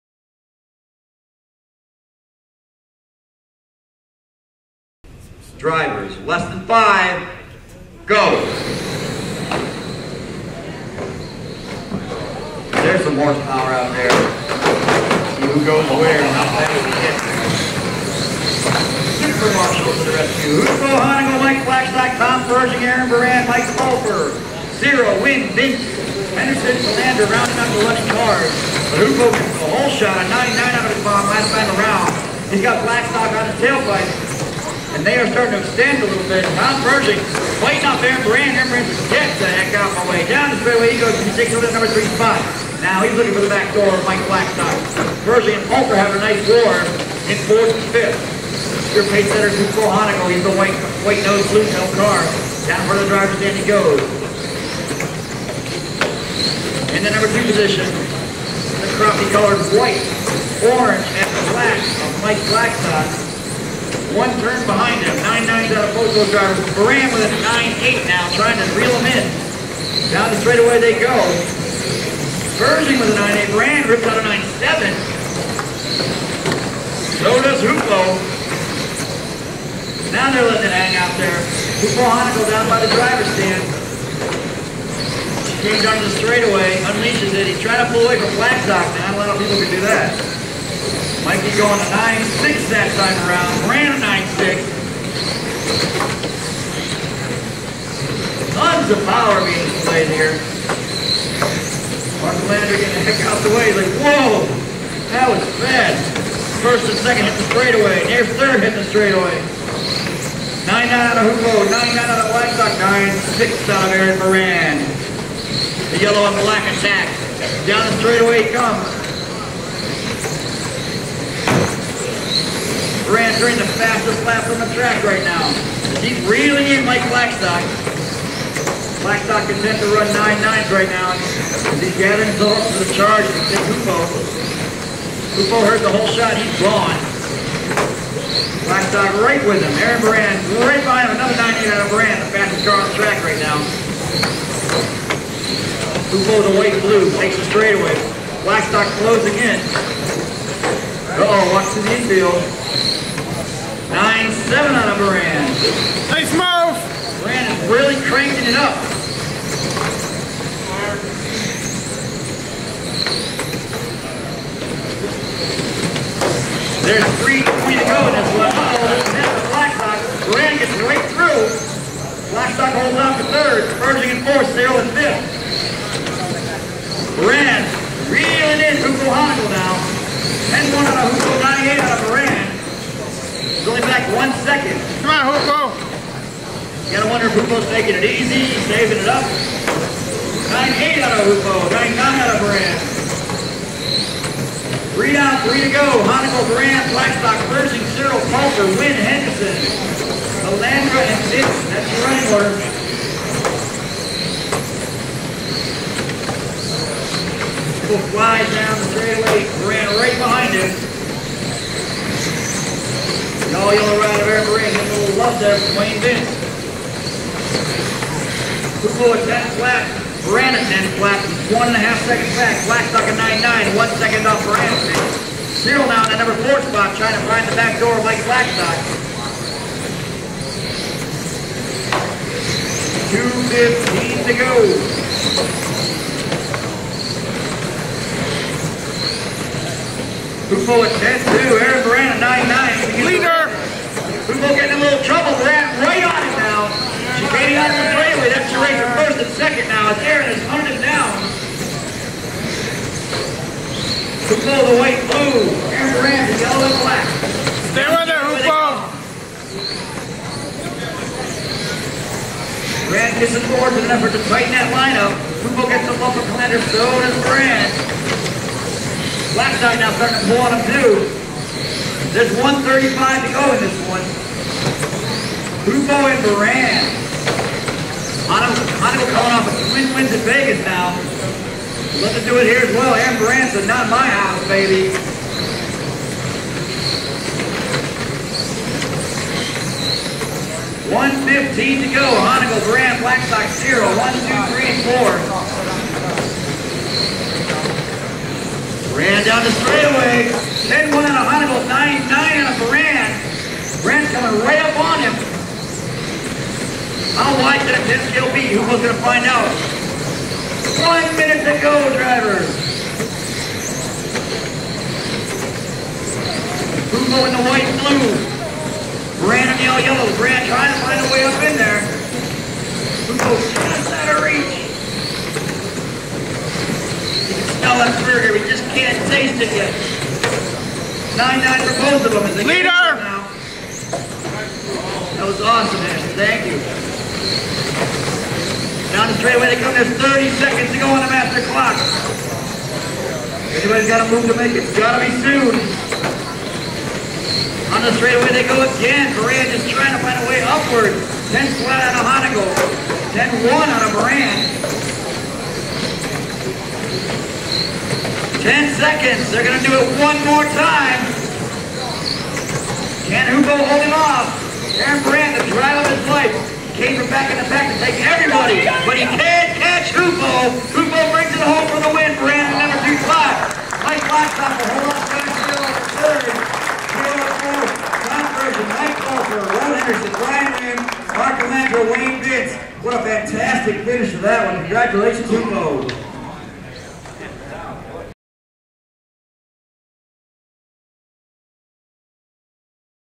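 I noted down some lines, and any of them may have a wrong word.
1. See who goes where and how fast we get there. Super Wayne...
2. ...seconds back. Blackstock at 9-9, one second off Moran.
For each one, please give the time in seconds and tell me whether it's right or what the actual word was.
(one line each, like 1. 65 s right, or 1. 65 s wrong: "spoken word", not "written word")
1. 15 s wrong: "Marshal", not "Wayne"
2. 222 s right.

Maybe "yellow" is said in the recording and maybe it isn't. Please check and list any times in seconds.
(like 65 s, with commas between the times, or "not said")
116 s, 213 s, 256 s, 319 s.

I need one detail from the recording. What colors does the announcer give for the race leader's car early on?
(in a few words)
White nose, blue tail.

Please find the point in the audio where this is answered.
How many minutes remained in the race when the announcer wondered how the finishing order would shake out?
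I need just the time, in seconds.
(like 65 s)
310 s.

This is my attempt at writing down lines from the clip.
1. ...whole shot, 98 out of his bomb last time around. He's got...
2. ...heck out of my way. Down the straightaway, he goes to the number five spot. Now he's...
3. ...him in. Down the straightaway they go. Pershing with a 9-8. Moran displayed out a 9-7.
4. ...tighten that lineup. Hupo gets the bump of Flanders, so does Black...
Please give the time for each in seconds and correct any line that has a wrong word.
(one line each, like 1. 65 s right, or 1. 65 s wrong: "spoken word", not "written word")
1. 29 s wrong: "99", not "98"
2. 39 s wrong: "three", not "five"
3. 68 s wrong: "ripped", not "displayed"
4. 264 s right.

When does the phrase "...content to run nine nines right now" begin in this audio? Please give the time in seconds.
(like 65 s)
129 s.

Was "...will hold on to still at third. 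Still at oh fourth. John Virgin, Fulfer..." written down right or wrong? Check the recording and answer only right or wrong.
wrong.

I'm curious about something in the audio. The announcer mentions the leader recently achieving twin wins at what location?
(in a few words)
Vegas.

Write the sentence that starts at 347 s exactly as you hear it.
On the straightaway they go again.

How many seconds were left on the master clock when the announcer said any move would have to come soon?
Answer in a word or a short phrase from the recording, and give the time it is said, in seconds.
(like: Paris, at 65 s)
30, at 340 s.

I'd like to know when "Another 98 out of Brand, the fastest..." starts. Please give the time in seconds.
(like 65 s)
141 s.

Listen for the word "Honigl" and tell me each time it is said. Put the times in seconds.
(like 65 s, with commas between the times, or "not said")
20 s, 179 s, 352 s.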